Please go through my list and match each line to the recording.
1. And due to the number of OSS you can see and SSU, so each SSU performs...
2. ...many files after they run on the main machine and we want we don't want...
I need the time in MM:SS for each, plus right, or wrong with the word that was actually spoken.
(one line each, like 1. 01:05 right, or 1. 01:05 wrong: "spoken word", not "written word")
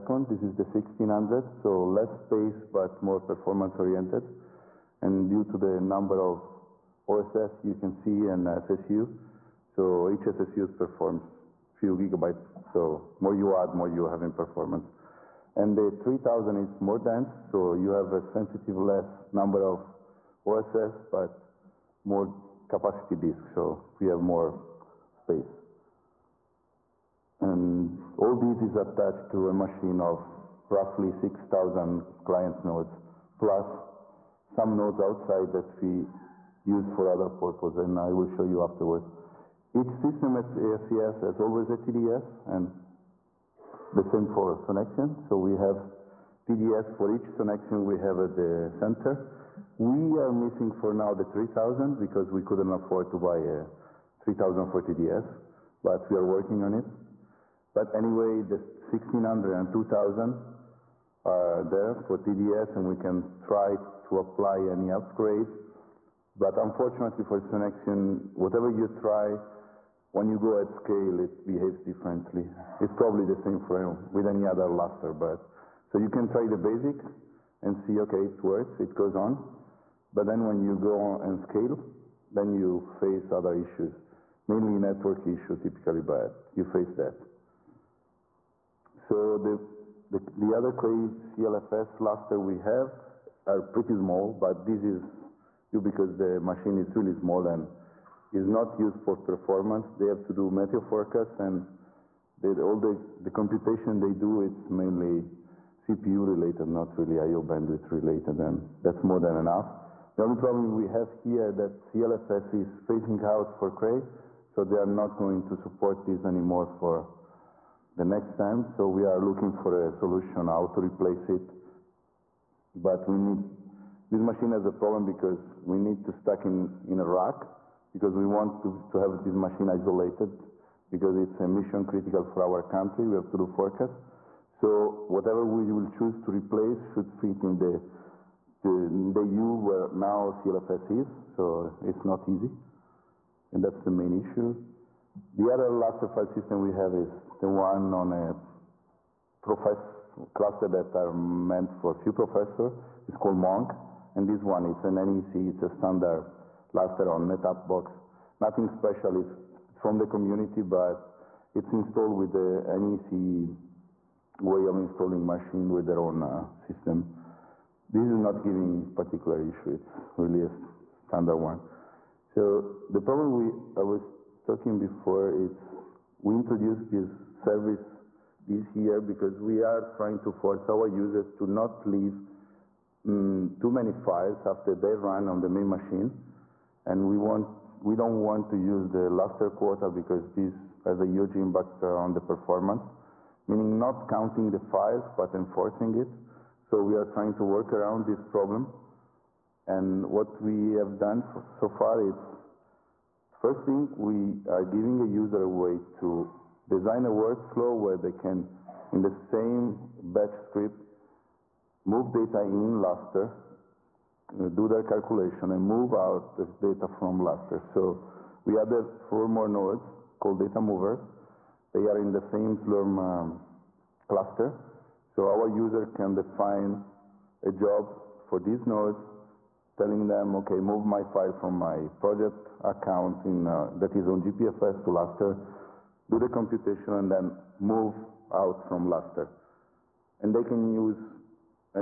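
1. 00:05 right
2. 03:03 right.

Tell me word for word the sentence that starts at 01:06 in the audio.
But unfortunately for Sonexion, whatever you try, when you go at scale, it behaves differently.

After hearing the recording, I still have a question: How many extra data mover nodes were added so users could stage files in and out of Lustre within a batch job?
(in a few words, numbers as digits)
4.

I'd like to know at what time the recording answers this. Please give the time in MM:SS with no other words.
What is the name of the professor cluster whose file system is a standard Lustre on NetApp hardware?
02:33.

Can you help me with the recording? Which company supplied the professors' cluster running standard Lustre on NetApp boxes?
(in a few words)
NEC.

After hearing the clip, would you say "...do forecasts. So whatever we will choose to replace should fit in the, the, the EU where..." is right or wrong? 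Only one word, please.
right.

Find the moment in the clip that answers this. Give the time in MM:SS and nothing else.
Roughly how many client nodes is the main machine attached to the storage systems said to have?
00:31.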